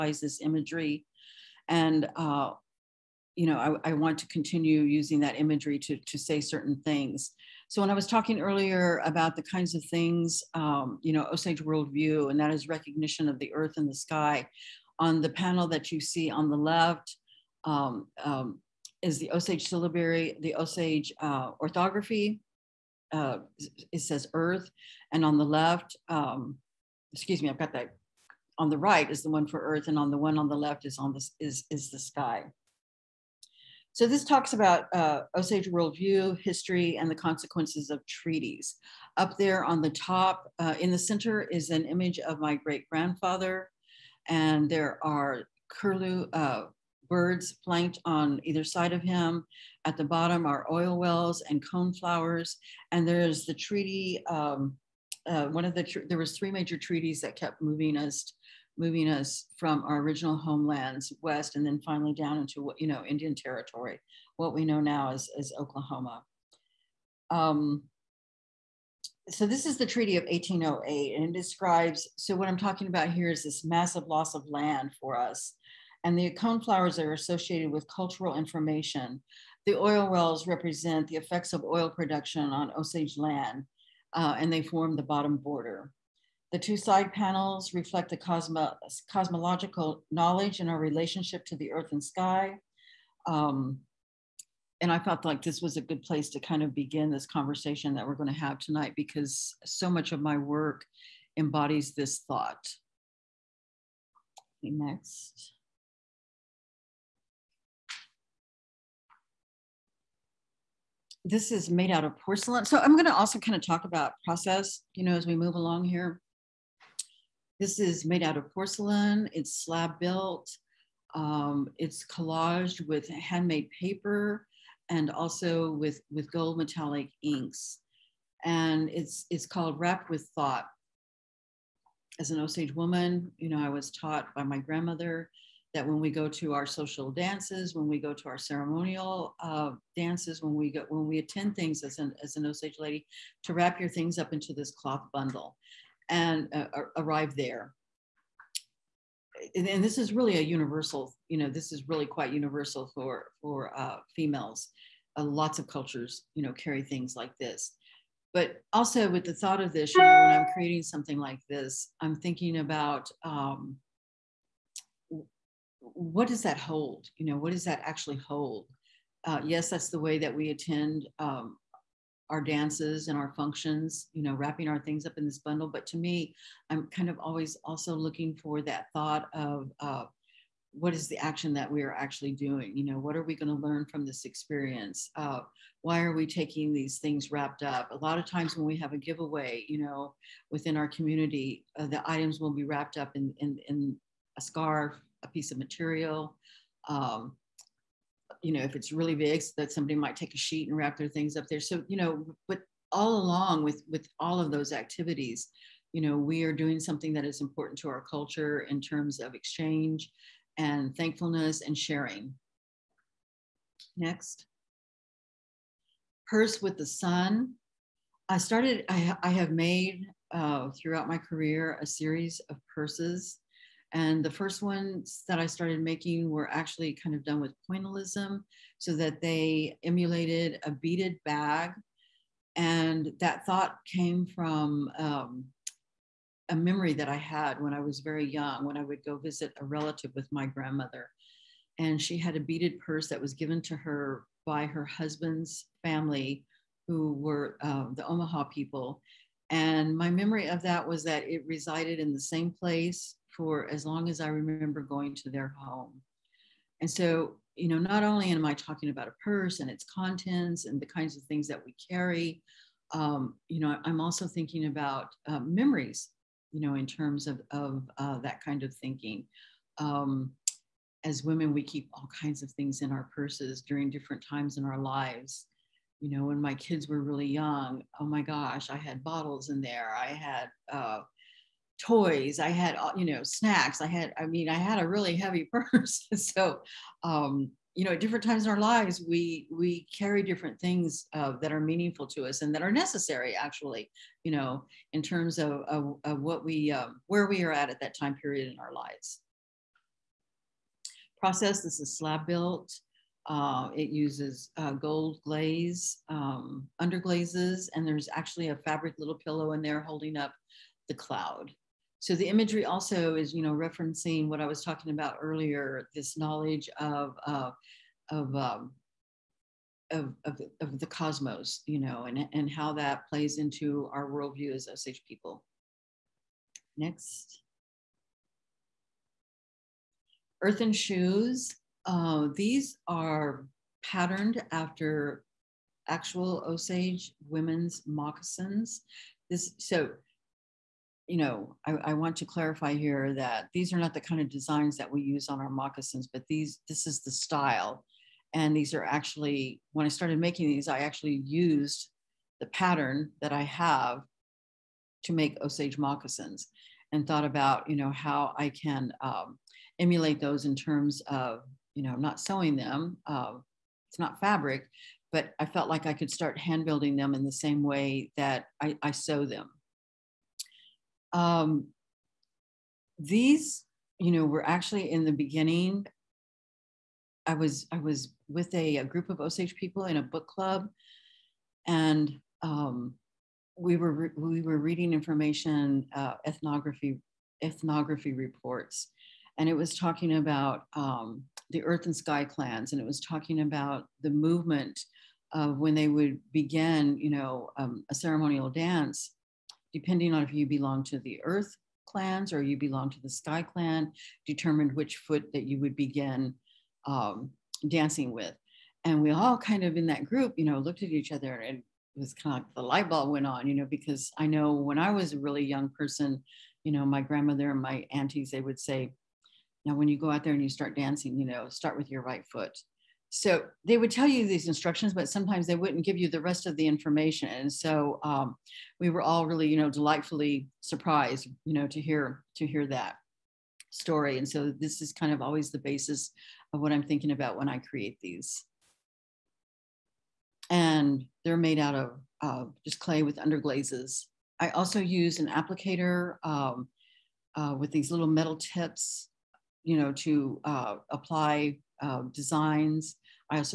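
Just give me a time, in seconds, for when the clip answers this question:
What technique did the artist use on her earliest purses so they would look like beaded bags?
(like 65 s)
227 s.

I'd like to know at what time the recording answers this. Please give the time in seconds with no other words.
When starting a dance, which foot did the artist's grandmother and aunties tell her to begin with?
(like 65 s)
422 s.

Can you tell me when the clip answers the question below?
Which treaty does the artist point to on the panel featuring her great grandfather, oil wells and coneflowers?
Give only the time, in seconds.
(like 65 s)
69 s.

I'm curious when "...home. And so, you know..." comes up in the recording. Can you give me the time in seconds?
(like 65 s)
255 s.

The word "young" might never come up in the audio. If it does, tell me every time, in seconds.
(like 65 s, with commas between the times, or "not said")
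238 s, 277 s, 415 s.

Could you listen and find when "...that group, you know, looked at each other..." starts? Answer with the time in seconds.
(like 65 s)
409 s.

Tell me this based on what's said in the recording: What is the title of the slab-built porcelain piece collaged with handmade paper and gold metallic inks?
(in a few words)
Wrap with Thought.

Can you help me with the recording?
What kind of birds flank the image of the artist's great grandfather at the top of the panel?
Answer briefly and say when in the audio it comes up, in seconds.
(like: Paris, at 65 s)
Curlew, at 45 s.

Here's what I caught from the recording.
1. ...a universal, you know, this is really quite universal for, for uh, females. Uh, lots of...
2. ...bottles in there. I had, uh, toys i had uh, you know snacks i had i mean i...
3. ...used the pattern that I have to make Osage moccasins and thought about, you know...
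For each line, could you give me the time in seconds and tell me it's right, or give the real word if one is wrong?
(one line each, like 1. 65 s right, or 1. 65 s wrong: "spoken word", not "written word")
1. 150 s right
2. 279 s right
3. 351 s right.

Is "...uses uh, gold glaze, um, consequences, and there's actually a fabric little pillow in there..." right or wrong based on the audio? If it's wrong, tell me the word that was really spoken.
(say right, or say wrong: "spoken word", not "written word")
wrong: "underglazes", not "consequences".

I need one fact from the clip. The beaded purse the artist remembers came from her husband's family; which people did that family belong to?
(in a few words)
Omaha.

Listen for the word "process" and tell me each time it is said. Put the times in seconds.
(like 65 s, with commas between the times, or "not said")
114 s, 301 s.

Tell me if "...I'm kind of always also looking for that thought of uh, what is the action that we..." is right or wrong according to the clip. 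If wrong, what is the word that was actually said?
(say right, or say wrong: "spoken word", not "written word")
right.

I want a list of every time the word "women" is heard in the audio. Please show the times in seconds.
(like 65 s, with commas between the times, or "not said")
271 s, 337 s.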